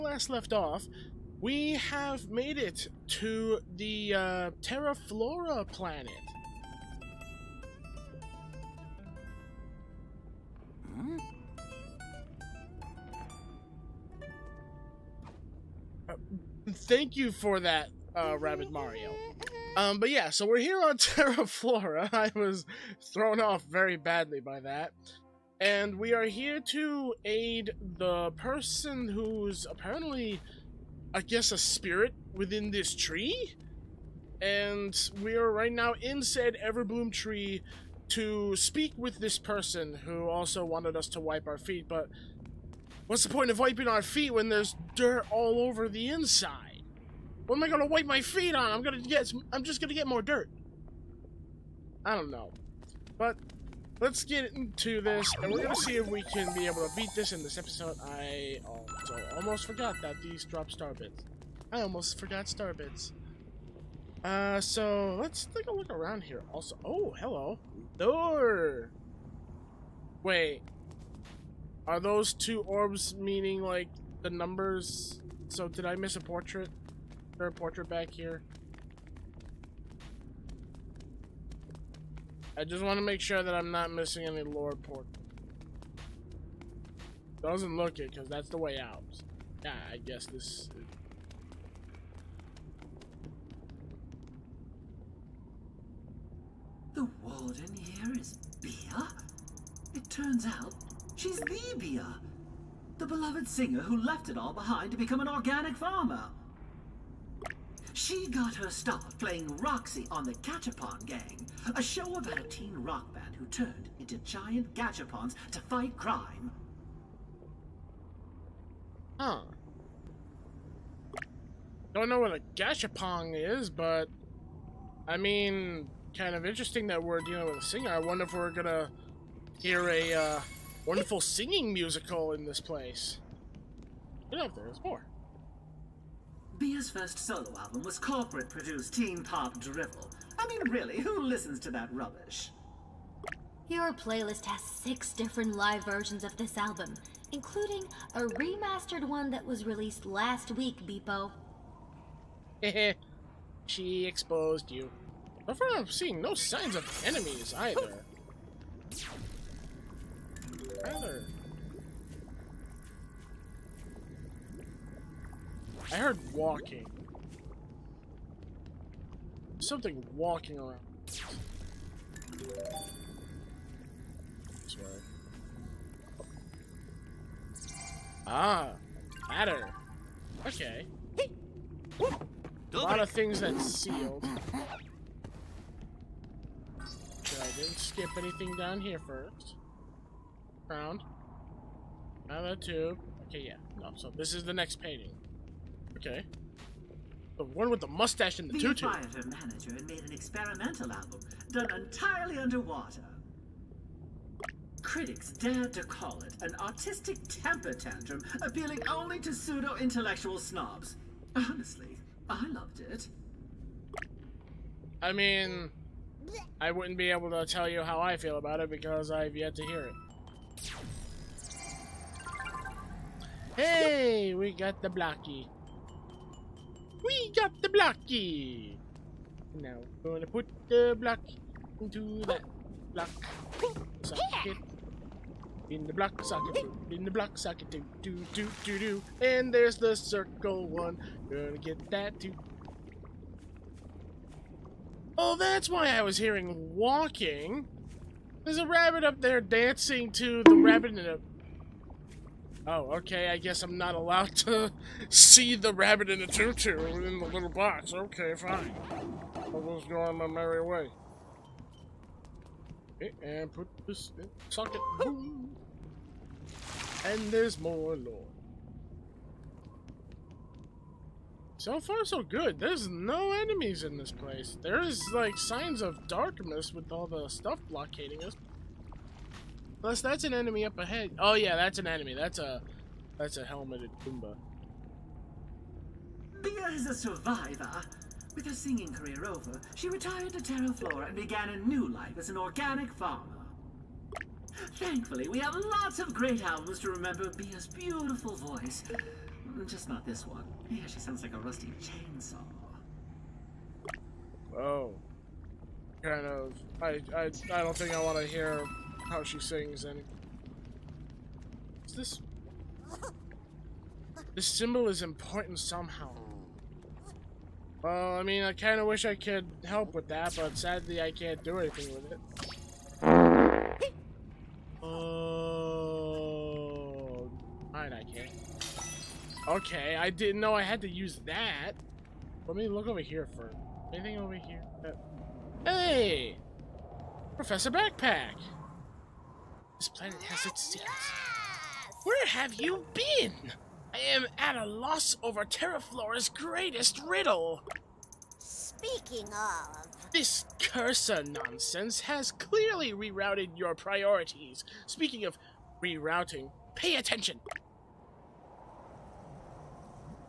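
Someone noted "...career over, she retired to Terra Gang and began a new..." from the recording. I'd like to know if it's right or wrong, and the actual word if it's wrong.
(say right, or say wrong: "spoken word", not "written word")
wrong: "Flora", not "Gang".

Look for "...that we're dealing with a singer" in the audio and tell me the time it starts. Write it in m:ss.
2:06.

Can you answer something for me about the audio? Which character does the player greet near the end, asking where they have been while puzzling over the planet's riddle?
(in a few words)
Professor Backpack.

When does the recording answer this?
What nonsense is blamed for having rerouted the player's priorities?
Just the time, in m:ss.
5:50.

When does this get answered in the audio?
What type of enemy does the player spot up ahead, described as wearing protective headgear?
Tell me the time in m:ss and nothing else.
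4:43.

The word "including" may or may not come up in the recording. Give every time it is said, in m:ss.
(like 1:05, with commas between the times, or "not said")
2:27.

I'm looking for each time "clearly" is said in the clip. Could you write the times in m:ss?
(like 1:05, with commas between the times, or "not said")
5:52.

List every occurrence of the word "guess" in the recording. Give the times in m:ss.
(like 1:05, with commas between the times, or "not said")
0:31, 1:29, 4:13.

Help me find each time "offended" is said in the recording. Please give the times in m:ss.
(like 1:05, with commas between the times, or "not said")
not said.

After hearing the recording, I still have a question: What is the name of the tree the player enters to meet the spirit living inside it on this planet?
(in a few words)
Everbloom tree.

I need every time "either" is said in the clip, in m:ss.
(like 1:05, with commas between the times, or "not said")
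2:37.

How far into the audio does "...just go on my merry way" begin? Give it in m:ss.
4:19.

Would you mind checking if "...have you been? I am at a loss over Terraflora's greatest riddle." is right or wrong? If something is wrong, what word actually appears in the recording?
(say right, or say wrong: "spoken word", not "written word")
right.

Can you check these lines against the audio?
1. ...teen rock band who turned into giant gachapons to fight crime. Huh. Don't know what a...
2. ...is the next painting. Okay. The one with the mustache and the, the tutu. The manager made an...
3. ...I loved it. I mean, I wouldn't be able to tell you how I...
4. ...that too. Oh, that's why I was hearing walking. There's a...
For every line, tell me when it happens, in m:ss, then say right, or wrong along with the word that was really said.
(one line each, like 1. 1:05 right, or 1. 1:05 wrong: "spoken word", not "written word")
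1. 1:52 right
2. 3:14 right
3. 3:32 right
4. 4:01 right.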